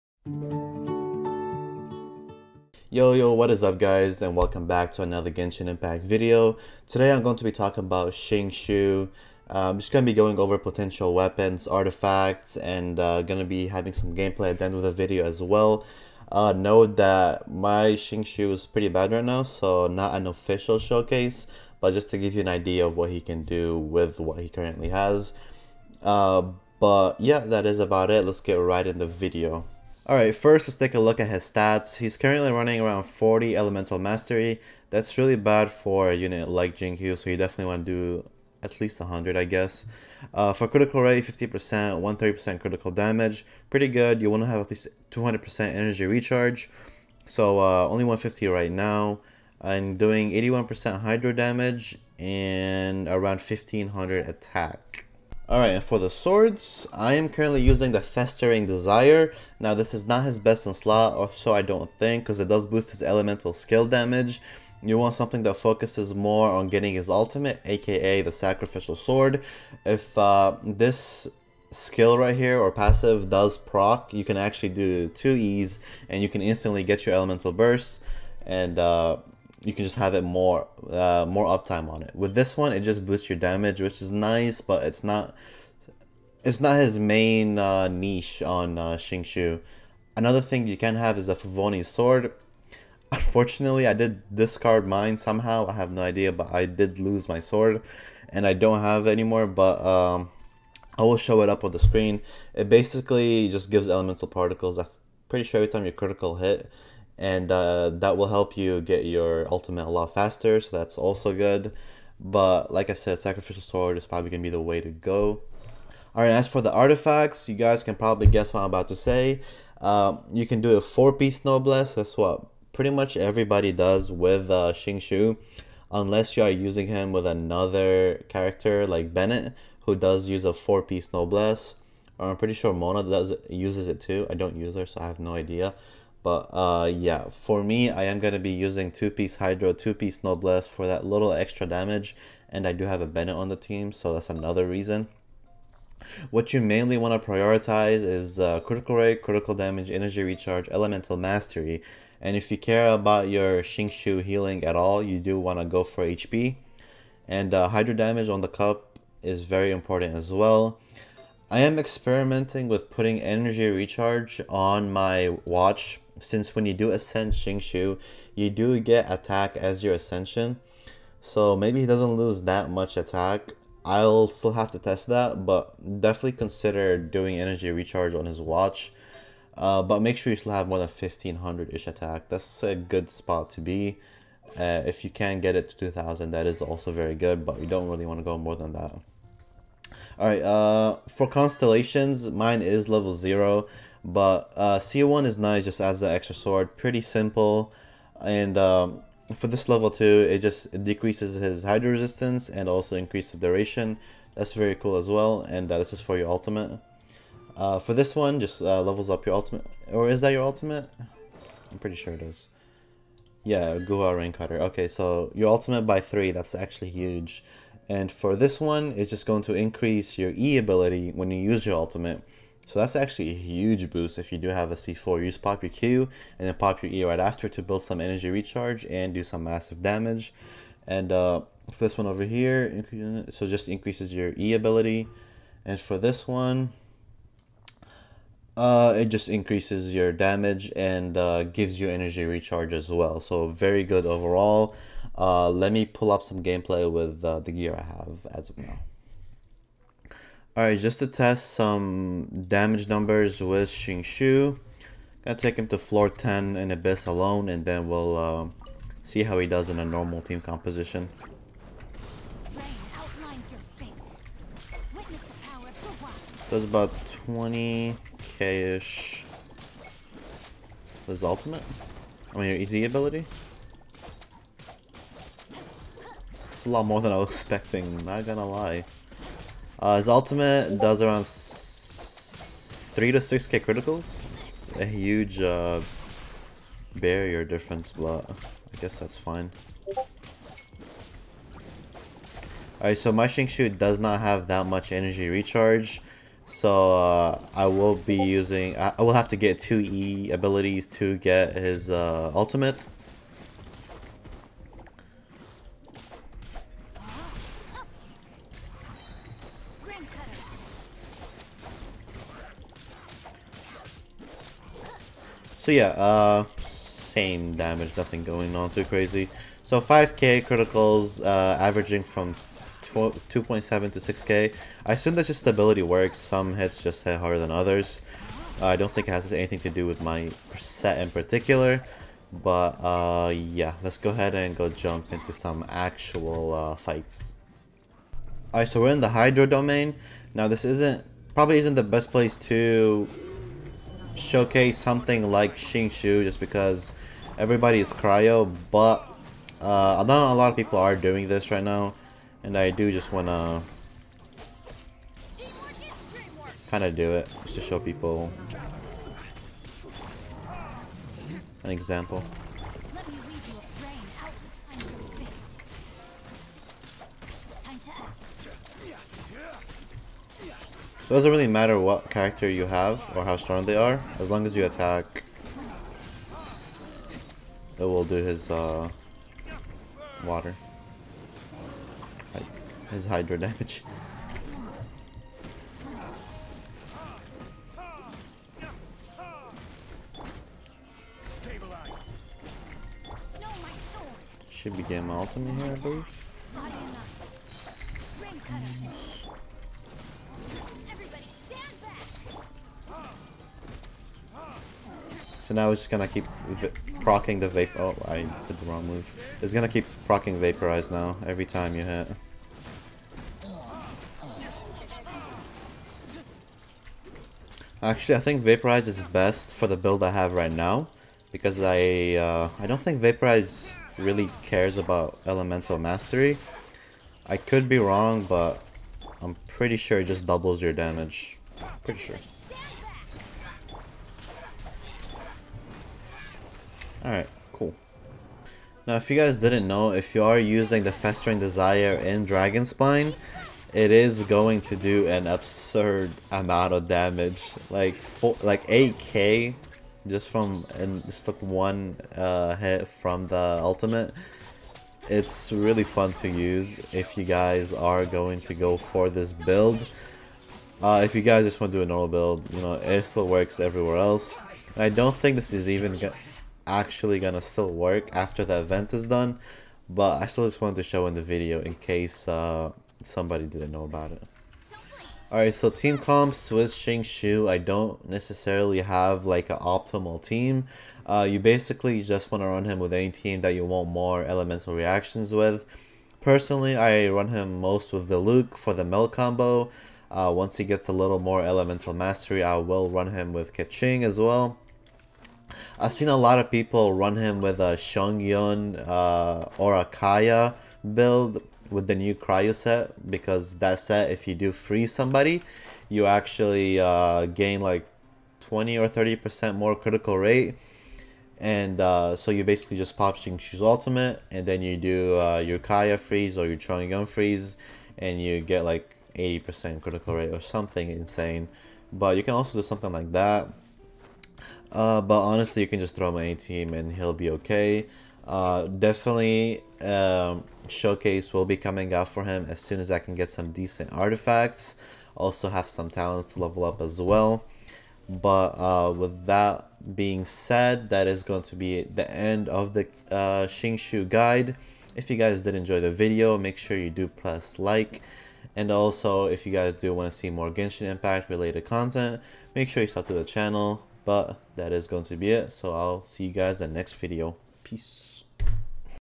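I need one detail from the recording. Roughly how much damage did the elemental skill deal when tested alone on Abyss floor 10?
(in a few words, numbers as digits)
20k.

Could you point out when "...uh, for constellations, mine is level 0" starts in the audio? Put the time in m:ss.
3:10.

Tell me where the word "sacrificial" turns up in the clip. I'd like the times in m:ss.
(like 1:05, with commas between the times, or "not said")
1:08, 1:53.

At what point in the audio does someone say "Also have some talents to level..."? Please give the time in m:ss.
8:55.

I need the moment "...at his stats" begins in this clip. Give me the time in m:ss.
0:31.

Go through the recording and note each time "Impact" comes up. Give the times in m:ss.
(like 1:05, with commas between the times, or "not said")
0:05, 9:10.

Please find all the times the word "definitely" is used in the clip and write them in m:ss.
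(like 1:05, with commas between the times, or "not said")
0:37, 2:56, 8:48.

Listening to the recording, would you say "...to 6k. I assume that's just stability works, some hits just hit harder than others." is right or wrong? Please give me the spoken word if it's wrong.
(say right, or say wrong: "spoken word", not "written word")
right.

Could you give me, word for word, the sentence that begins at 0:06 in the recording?
Today I'm going to be talking about Xingqiu.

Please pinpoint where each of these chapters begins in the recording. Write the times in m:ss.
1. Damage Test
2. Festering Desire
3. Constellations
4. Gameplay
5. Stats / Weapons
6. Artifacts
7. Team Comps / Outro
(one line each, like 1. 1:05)
1. 4:10
2. 7:18
3. 3:10
4. 5:38
5. 0:29
6. 1:56
7. 8:00.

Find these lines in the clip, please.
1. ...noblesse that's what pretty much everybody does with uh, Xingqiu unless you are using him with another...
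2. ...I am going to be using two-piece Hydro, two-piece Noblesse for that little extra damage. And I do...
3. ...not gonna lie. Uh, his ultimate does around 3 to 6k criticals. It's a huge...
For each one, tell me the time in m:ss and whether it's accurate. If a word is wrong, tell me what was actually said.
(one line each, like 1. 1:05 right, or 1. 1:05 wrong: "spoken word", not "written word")
1. 2:01 right
2. 2:17 right
3. 4:38 right.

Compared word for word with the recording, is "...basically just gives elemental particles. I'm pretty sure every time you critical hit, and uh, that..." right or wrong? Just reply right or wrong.
right.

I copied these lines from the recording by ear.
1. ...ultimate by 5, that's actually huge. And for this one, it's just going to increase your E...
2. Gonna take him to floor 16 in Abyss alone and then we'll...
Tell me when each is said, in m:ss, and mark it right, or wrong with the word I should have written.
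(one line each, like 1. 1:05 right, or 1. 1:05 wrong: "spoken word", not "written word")
1. 3:35 wrong: "3", not "5"
2. 4:15 wrong: "10", not "16".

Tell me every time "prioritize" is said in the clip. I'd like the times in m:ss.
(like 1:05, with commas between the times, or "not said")
2:27.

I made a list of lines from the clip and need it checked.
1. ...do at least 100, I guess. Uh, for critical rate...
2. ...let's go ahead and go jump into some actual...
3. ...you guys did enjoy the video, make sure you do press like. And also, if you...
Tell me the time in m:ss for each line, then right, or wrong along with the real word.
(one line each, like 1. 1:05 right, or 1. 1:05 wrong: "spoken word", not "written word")
1. 0:37 right
2. 5:33 right
3. 9:05 right.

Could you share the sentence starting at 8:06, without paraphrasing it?
Personally, I run him most with the Luke for the Mel combo.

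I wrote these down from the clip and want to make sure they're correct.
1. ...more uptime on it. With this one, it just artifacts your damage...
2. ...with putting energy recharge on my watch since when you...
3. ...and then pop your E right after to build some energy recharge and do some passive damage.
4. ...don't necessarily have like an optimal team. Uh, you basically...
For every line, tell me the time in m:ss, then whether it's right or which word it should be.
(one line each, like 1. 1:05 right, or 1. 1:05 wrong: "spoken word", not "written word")
1. 1:21 wrong: "boosts", not "artifacts"
2. 2:42 right
3. 3:46 wrong: "massive", not "passive"
4. 7:57 right.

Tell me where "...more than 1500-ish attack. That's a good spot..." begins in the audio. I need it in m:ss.
3:00.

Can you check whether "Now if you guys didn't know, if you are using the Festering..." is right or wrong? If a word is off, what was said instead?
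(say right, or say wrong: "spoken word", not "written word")
right.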